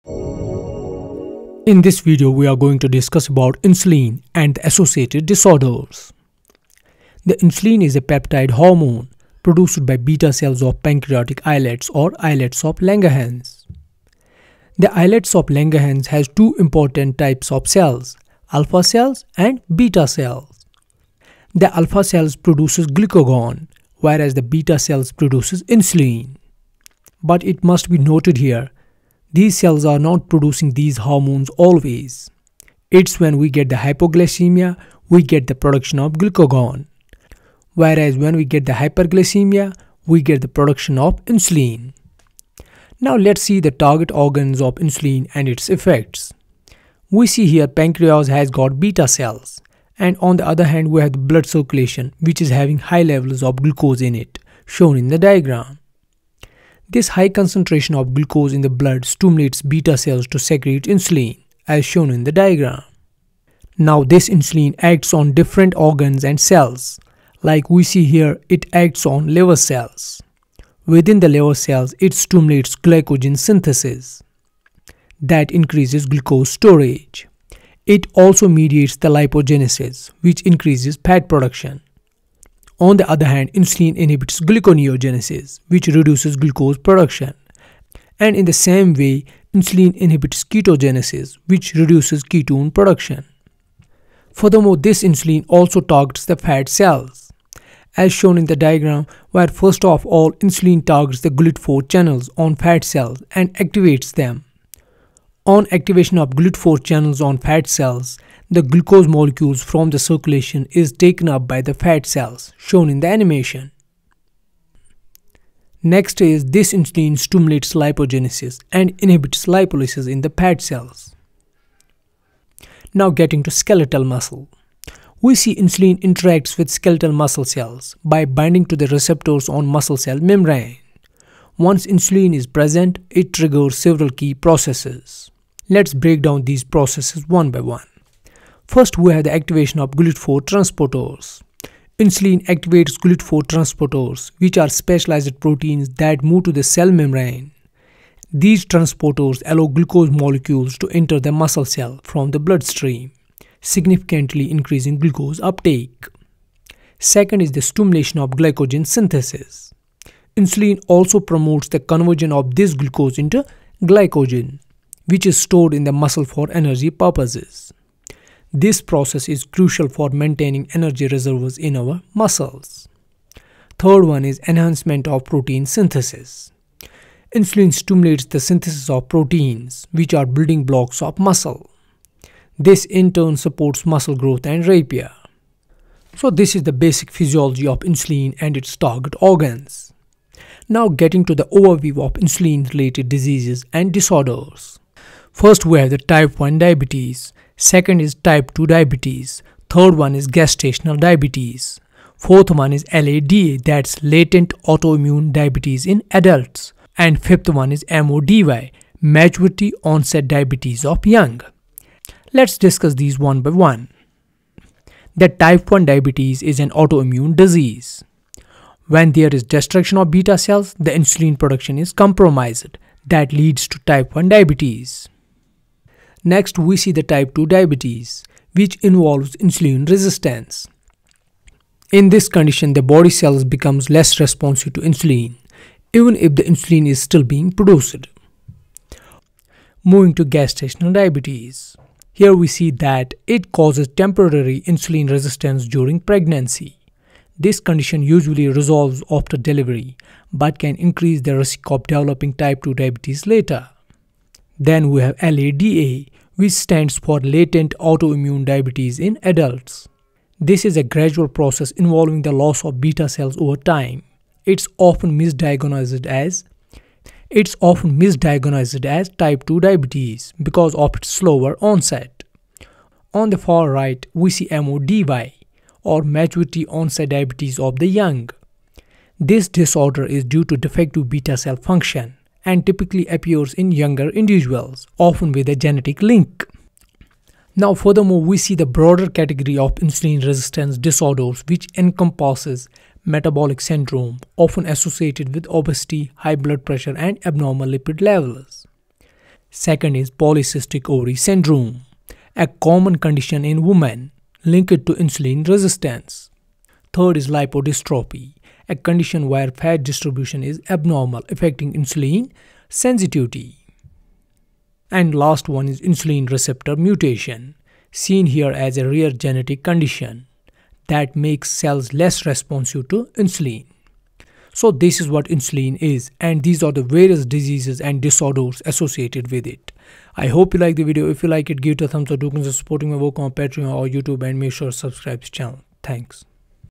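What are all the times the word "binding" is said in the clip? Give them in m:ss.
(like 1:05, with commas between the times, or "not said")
2:08.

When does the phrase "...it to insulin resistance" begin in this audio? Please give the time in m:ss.
5:04.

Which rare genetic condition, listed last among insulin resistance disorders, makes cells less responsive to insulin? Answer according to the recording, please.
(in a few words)
Insulin receptor mutation.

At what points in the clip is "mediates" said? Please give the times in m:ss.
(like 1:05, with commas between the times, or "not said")
1:18.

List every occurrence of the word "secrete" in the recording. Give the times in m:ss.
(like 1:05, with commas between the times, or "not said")
1:00.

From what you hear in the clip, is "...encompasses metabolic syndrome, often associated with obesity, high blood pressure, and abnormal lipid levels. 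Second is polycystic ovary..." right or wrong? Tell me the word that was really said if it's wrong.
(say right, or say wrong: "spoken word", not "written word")
right.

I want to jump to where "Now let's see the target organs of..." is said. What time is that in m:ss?
0:42.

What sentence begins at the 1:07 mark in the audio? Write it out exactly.
Like we see here, it acts on liver cells.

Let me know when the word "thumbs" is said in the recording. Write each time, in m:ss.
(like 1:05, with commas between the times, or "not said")
5:31.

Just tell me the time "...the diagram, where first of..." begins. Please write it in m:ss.
1:38.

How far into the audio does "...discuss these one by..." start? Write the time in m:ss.
3:32.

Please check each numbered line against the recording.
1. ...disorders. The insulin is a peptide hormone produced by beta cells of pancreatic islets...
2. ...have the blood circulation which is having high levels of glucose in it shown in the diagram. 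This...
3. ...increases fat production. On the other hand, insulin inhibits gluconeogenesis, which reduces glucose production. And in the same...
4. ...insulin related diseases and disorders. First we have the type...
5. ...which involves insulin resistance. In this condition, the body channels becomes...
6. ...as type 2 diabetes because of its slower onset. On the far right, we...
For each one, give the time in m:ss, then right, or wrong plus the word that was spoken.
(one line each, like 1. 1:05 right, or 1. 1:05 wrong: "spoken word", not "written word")
1. 0:05 right
2. 0:51 right
3. 1:20 right
4. 3:12 right
5. 3:48 wrong: "cells", not "channels"
6. 4:28 right.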